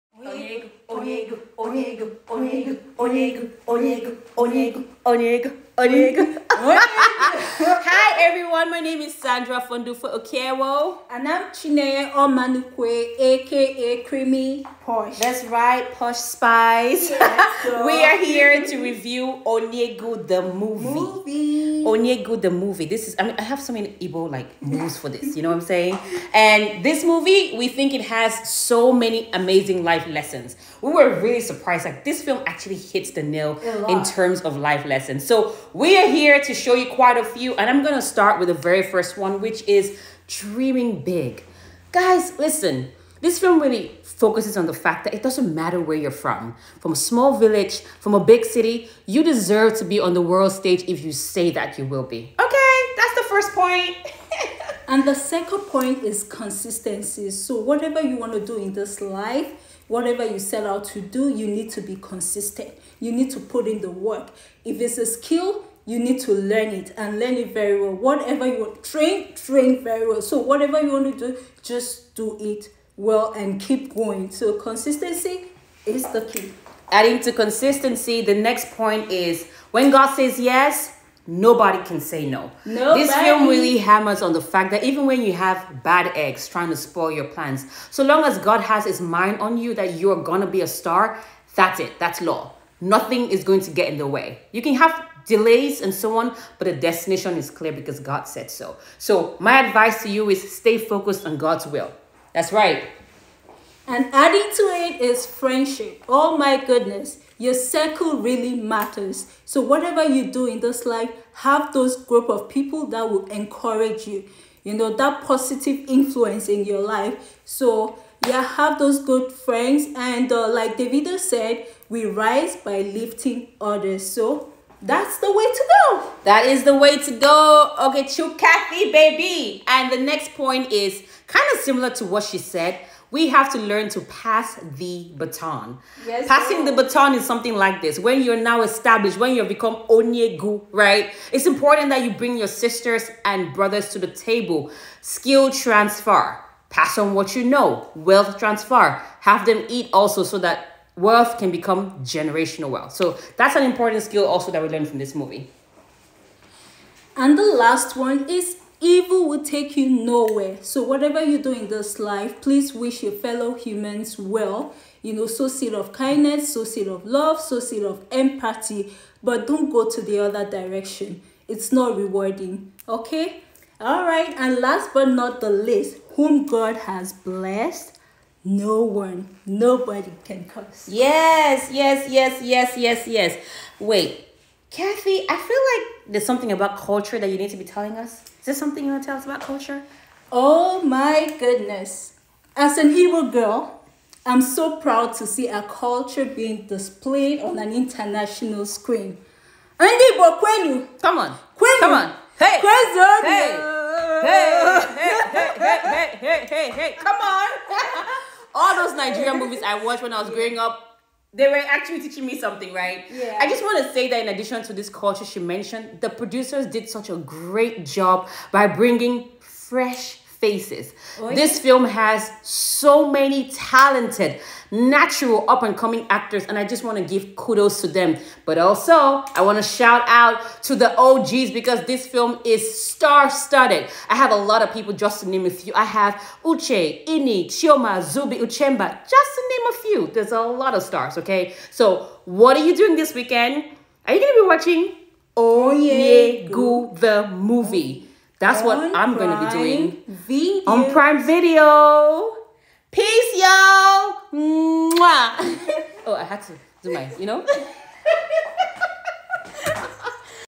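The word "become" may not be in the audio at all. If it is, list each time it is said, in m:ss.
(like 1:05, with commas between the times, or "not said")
2:19, 2:31.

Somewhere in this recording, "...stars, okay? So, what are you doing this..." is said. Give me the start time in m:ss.
4:00.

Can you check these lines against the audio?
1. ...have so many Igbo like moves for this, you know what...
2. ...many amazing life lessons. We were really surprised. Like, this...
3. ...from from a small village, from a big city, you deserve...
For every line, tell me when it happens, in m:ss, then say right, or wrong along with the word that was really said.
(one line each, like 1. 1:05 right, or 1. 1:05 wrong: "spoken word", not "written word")
1. 0:23 right
2. 0:28 right
3. 0:46 right.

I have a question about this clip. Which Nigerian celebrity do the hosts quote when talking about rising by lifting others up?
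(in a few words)
Davido.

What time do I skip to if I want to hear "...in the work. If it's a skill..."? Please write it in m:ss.
1:03.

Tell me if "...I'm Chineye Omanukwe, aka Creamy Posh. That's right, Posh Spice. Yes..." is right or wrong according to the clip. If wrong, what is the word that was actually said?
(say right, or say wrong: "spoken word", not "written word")
right.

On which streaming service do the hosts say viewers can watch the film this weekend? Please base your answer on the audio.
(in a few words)
Prime Video.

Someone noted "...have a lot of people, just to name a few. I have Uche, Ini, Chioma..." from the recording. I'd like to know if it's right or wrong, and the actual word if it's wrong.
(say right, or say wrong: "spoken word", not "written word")
right.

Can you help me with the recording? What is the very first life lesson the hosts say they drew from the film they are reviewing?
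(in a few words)
Dreaming Big.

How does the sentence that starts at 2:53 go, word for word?
All right, and last but not the least, whom God has blessed, no one, nobody can curse.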